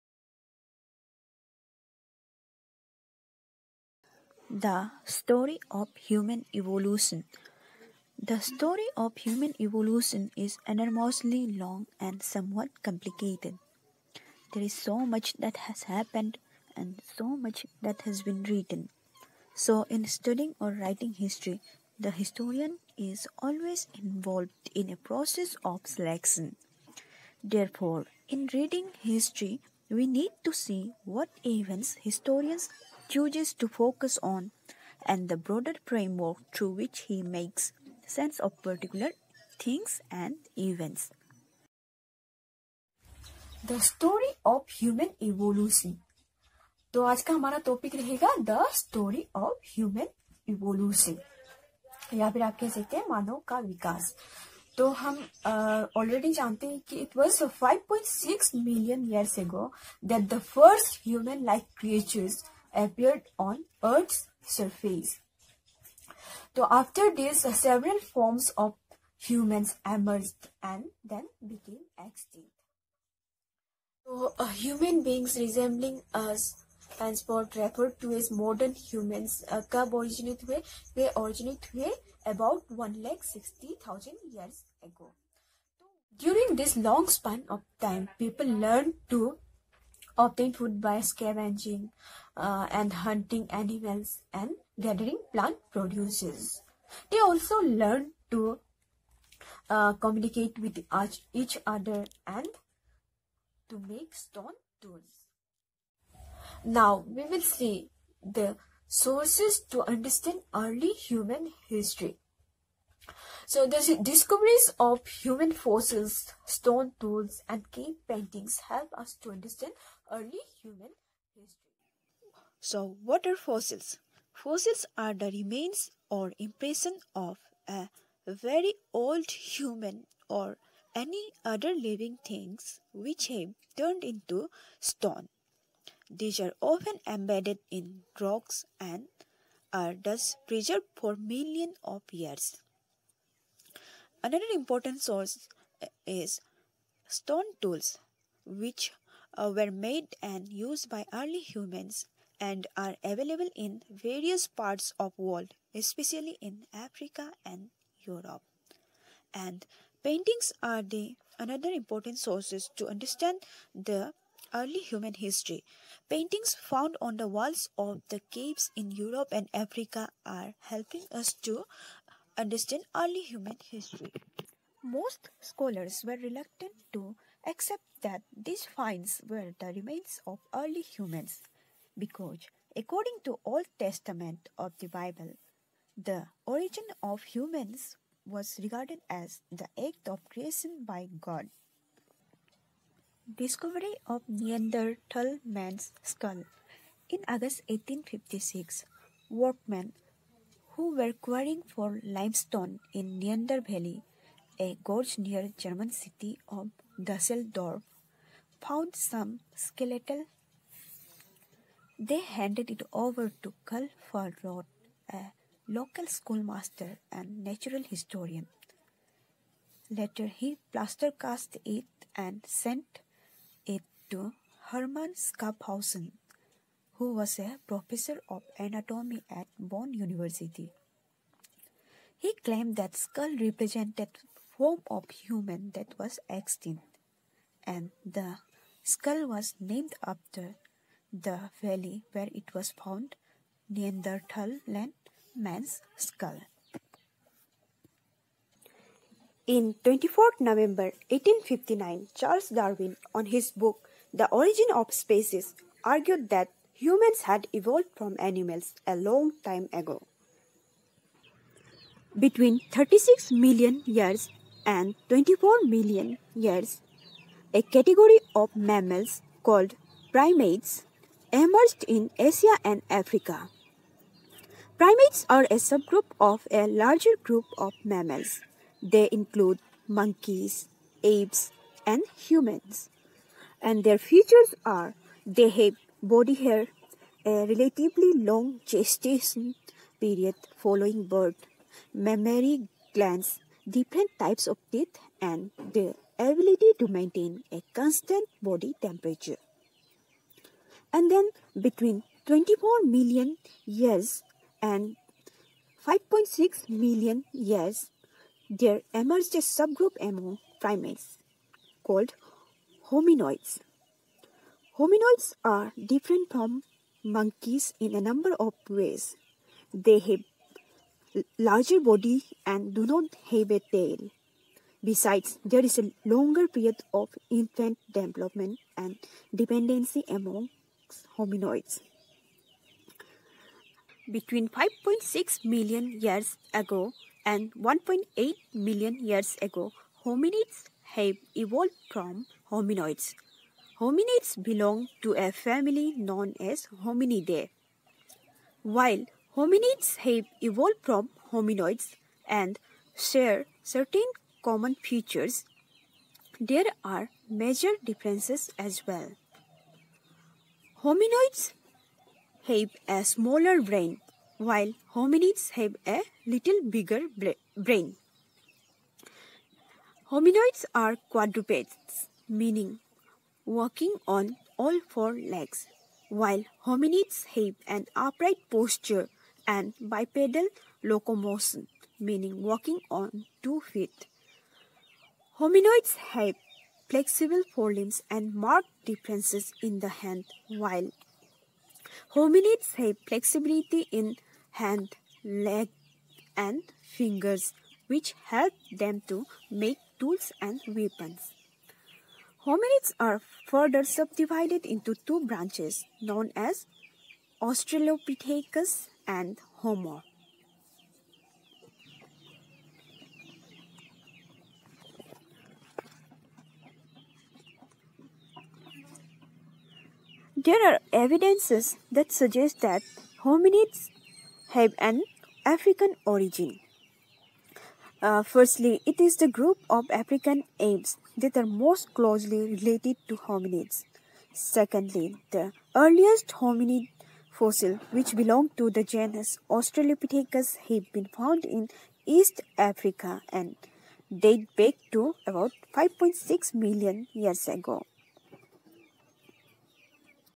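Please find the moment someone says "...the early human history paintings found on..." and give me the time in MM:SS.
02:43.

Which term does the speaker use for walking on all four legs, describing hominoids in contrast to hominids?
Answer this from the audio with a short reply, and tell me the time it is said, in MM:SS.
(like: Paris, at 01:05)
quadrupeds, at 06:11.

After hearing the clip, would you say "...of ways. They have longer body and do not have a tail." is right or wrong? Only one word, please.
wrong.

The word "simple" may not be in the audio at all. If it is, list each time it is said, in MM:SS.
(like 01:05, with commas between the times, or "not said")
not said.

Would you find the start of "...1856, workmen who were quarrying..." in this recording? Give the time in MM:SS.
03:17.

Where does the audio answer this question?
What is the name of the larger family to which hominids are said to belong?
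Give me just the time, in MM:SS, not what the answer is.
05:46.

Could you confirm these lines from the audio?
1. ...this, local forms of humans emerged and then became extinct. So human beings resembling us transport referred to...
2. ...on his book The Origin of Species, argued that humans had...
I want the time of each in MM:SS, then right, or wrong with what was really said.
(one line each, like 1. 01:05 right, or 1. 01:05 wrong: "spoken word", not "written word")
1. 01:07 wrong: "several", not "local"
2. 04:13 right.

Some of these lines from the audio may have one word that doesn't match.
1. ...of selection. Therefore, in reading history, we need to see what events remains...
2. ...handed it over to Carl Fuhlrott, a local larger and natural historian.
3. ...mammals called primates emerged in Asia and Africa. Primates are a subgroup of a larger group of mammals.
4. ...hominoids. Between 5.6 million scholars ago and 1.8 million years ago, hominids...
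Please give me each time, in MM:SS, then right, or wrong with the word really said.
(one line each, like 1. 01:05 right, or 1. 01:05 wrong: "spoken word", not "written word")
1. 00:25 wrong: "historians", not "remains"
2. 03:32 wrong: "schoolmaster", not "larger"
3. 04:28 right
4. 05:31 wrong: "years", not "scholars".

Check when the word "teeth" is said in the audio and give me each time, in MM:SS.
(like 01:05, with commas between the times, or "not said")
04:54.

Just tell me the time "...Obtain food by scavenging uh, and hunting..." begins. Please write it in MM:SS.
01:30.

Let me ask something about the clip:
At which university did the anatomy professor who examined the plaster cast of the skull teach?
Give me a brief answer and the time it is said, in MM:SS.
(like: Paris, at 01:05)
Bonn University, at 03:49.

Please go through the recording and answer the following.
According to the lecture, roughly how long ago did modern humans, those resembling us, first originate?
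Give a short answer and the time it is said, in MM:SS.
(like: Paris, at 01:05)
160,000 years ago, at 01:22.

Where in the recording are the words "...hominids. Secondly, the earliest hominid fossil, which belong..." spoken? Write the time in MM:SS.
07:13.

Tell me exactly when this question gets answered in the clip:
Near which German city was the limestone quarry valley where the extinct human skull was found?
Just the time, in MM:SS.
03:26.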